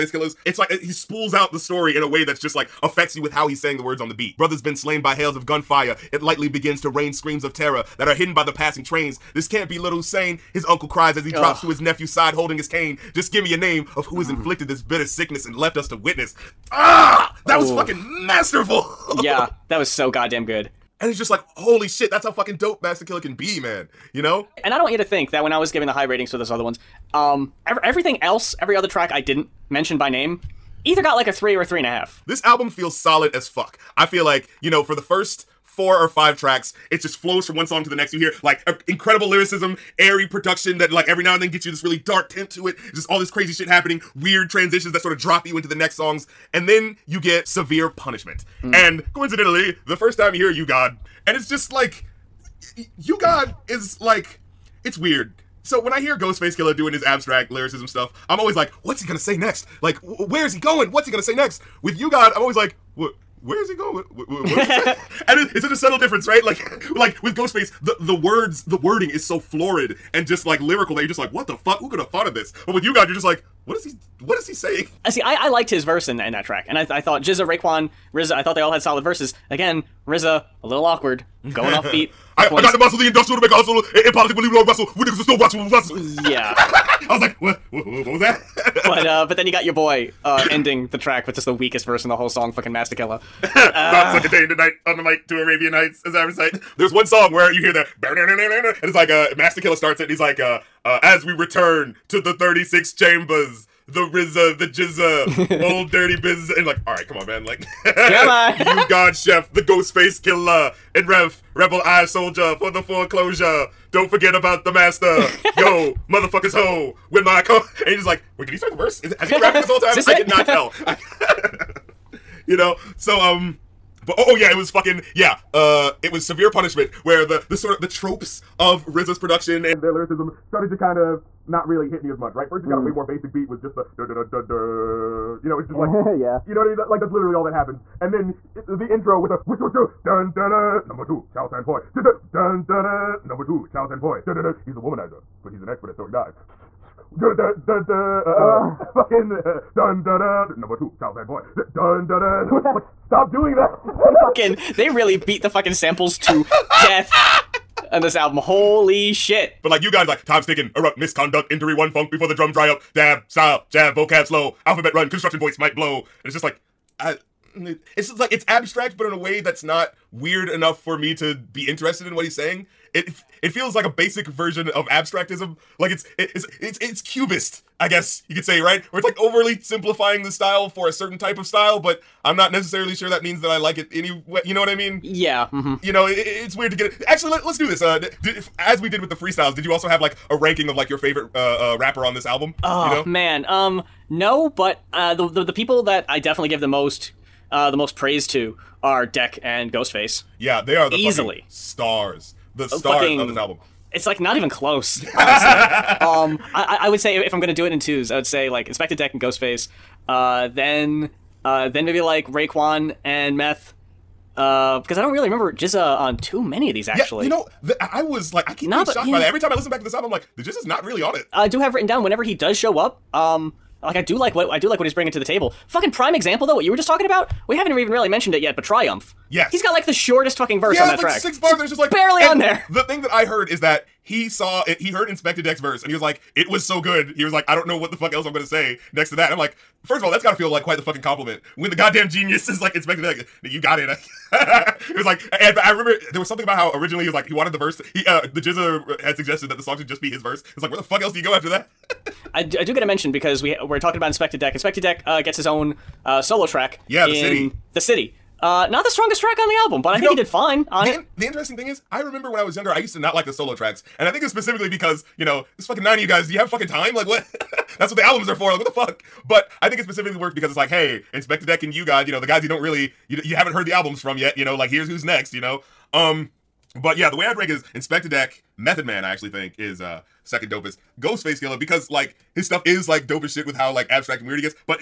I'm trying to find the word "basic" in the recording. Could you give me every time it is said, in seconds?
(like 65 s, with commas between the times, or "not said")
133 s, 173 s.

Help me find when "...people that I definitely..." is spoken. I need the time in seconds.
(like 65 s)
195 s.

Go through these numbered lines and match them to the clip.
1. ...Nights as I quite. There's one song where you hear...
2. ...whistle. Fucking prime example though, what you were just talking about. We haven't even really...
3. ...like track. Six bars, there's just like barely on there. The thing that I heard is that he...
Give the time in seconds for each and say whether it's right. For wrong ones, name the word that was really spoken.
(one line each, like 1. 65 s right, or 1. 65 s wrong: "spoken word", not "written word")
1. 95 s wrong: "recite", not "quite"
2. 225 s wrong: "table", not "whistle"
3. 230 s right.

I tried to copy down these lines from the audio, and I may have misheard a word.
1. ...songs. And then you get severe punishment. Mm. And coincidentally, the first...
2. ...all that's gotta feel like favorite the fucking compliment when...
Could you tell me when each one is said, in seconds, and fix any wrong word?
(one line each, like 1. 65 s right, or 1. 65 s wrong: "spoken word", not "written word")
1. 45 s right
2. 240 s wrong: "quite", not "favorite".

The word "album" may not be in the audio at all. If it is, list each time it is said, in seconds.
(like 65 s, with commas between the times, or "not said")
32 s, 158 s, 192 s, 203 s, 219 s, 259 s, 268 s, 273 s.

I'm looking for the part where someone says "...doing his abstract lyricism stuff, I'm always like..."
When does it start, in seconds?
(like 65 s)
56 s.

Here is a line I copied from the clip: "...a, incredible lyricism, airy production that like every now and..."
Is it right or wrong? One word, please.
right.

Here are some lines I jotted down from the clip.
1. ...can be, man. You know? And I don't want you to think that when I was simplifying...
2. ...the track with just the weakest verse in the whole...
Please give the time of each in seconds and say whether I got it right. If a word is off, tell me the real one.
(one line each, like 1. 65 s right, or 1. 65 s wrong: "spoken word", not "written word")
1. 23 s wrong: "giving", not "simplifying"
2. 90 s right.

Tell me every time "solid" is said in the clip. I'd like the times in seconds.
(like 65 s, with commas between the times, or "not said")
32 s, 78 s.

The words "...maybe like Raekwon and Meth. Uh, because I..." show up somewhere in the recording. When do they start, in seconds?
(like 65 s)
211 s.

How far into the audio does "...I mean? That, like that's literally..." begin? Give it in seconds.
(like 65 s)
136 s.